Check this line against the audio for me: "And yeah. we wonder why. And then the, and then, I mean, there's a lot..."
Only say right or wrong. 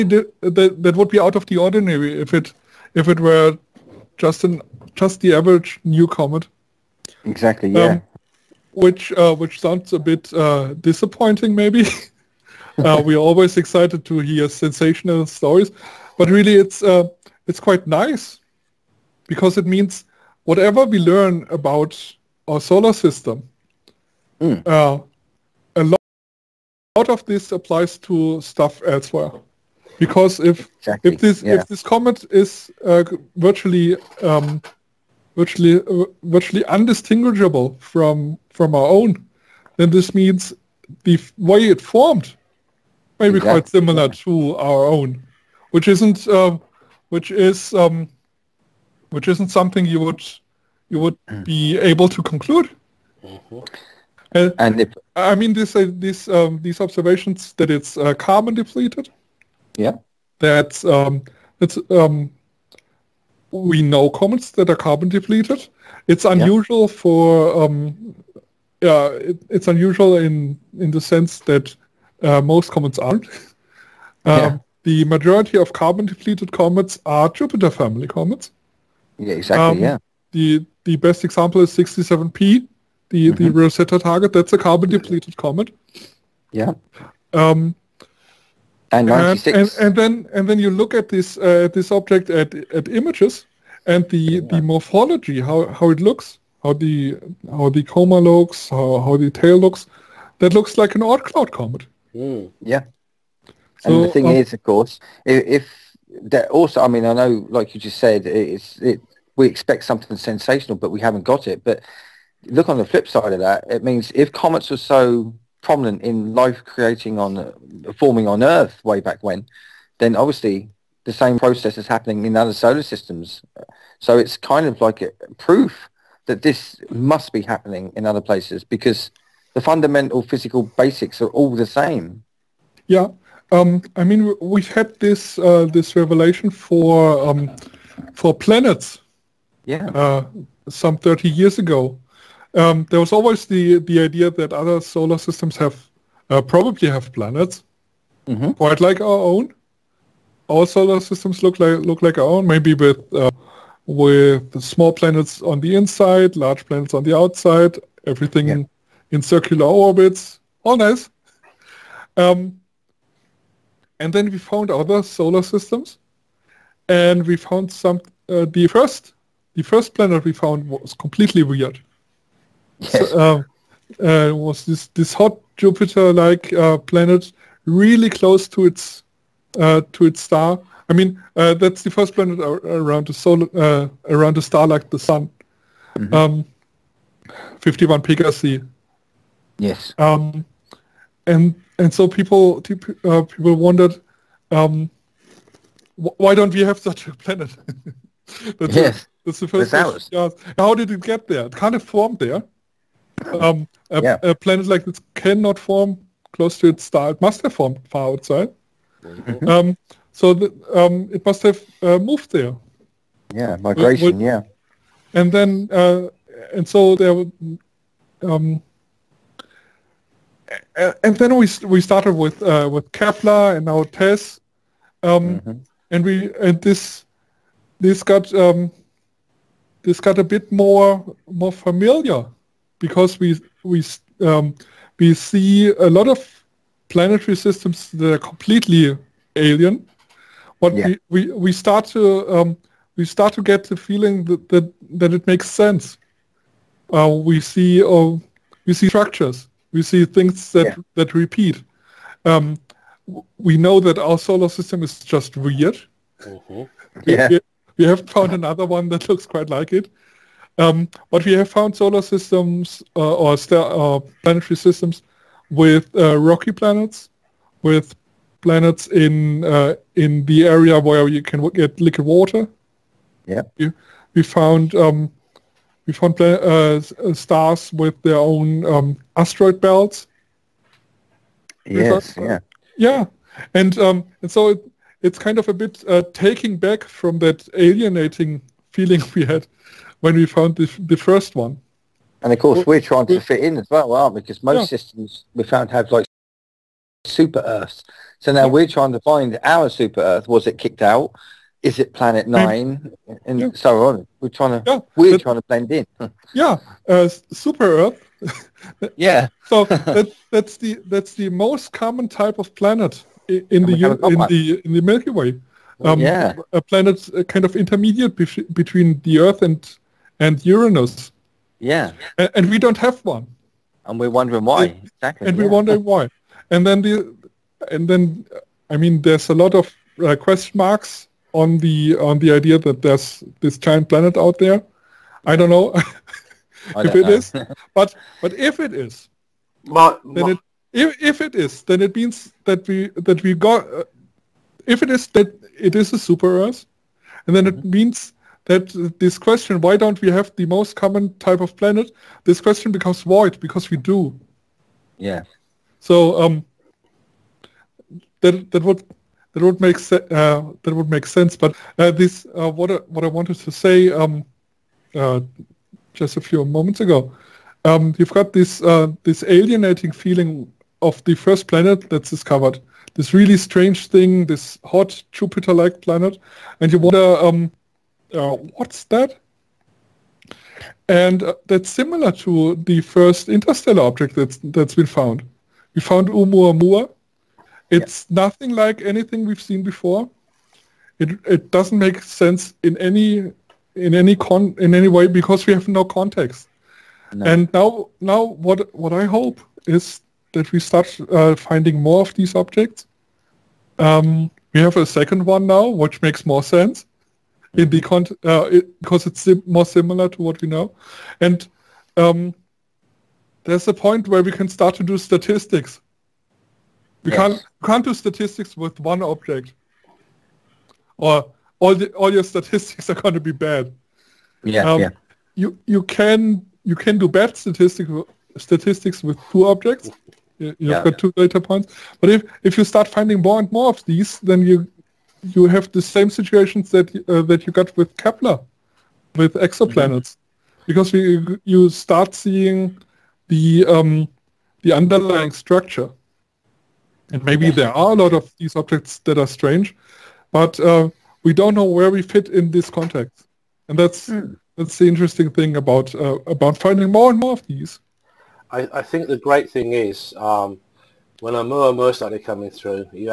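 right.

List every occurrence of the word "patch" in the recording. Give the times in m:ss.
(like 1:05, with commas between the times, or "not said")
not said.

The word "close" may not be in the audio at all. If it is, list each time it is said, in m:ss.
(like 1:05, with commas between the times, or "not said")
2:58, 3:26.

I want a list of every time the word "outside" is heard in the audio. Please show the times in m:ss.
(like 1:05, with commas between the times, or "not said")
2:37, 3:28.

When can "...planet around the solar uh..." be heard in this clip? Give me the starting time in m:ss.
3:02.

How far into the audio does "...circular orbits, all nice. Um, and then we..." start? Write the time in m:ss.
2:39.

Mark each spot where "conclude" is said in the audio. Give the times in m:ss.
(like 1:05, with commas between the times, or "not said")
0:52.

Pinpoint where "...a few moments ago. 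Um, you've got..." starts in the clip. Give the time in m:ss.
6:06.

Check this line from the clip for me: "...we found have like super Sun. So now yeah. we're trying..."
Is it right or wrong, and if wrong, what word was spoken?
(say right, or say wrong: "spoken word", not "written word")
wrong: "Earths", not "Sun".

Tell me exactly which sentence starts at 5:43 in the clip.
Uh, if it is that it is a super Earth, and then mm -hmm.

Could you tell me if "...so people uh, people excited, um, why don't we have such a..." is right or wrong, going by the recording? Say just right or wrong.
wrong.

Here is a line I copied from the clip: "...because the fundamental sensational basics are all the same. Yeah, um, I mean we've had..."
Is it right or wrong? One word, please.
wrong.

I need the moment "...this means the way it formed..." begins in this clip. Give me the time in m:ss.
0:39.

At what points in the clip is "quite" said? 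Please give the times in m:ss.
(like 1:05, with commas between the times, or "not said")
0:17, 0:43, 2:28, 4:19.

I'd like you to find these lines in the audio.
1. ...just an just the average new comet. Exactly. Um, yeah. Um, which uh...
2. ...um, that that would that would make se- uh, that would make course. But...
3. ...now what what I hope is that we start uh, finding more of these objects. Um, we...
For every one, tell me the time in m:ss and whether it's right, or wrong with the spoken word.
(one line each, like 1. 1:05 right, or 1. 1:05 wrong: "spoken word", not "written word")
1. 0:04 right
2. 5:56 wrong: "sense", not "course"
3. 6:38 right.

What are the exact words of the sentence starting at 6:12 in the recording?
This really strange thing, this hot Jupiter-like planet, and you wonder um, uh, what's that?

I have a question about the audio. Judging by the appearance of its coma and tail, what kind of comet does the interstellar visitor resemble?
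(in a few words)
Oort cloud comet.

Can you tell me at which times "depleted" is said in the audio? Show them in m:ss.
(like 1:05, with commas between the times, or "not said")
0:58, 1:05, 1:16, 1:24.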